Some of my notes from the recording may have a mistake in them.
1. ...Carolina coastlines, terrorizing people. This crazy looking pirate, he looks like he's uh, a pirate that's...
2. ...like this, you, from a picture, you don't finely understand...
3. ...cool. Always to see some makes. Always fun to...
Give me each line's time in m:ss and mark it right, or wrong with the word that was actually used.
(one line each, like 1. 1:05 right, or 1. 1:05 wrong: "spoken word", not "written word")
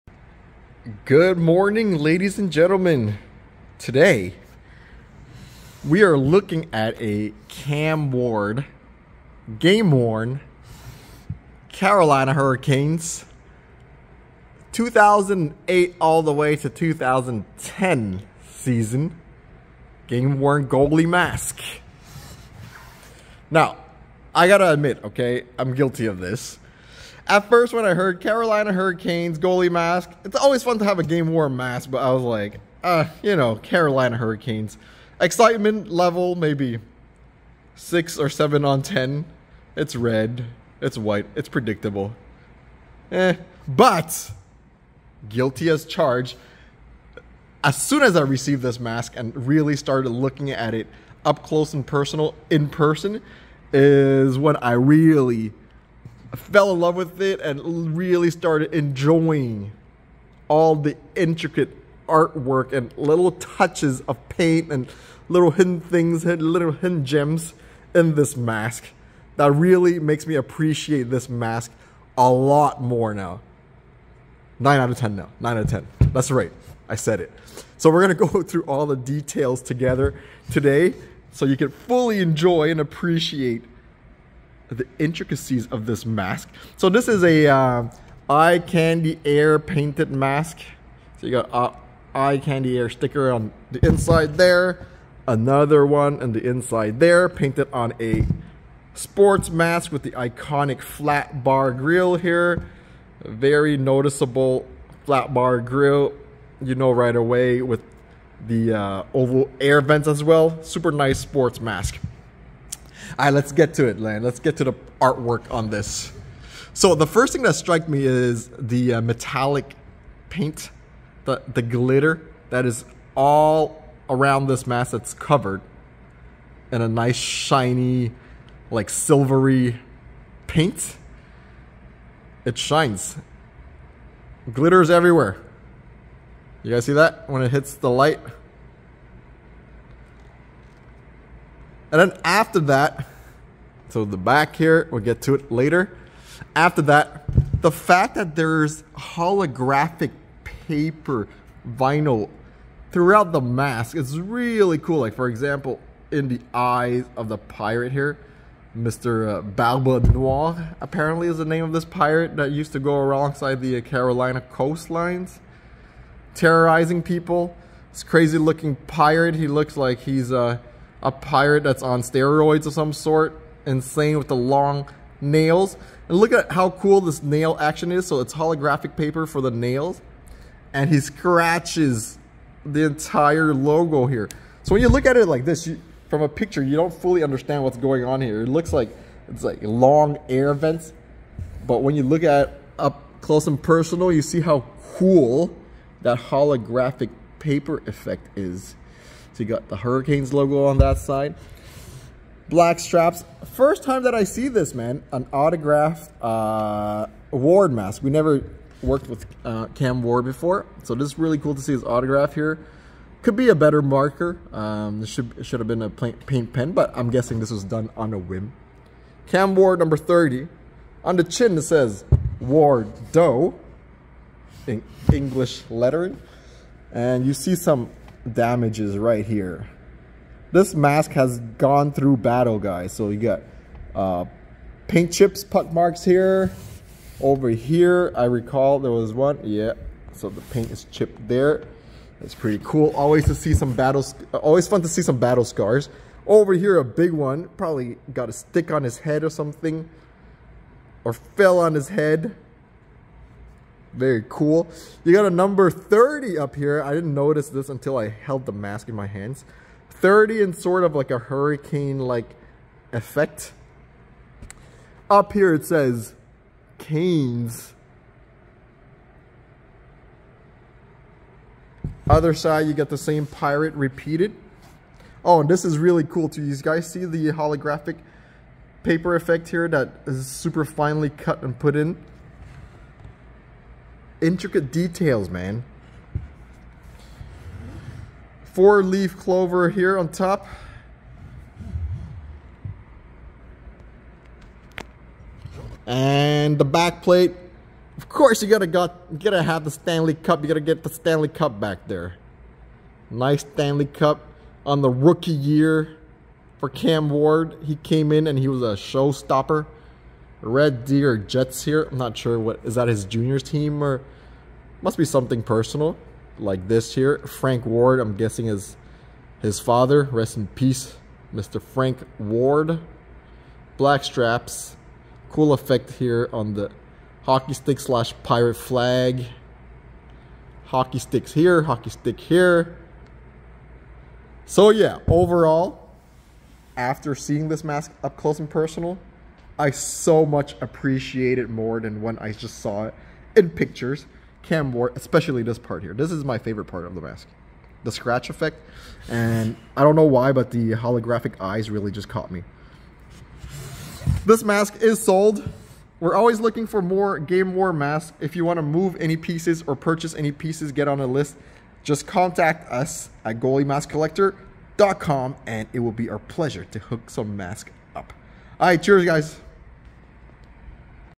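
1. 2:43 right
2. 3:05 wrong: "fully", not "finely"
3. 4:02 wrong: "battles", not "makes".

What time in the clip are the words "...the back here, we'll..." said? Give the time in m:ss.
2:24.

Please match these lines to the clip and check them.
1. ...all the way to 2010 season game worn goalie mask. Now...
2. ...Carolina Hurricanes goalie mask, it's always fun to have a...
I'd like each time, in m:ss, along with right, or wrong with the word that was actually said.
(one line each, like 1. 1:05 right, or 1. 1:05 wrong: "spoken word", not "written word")
1. 0:16 right
2. 0:28 right.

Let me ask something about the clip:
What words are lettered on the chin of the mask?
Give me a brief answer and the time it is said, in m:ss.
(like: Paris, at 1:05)
Ward Doe, at 3:42.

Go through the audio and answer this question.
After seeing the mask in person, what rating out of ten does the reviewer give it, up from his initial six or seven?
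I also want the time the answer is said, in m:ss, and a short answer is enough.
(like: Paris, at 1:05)
9 out of 10, at 1:14.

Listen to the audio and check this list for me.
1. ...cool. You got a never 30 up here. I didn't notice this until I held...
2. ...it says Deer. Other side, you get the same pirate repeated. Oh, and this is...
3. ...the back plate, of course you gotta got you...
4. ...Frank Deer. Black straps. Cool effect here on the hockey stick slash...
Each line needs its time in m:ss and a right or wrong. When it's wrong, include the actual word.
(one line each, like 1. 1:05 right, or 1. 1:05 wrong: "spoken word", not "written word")
1. 4:14 wrong: "number", not "never"
2. 4:25 wrong: "Canes", not "Deer"
3. 4:56 right
4. 5:21 wrong: "Ward", not "Deer".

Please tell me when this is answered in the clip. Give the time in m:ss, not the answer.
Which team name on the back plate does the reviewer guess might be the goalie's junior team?
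5:10.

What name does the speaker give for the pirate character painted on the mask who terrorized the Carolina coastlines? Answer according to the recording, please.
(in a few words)
Barbe Noire.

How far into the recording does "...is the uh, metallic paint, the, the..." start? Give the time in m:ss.
1:58.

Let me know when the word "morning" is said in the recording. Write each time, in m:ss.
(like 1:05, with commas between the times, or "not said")
0:01.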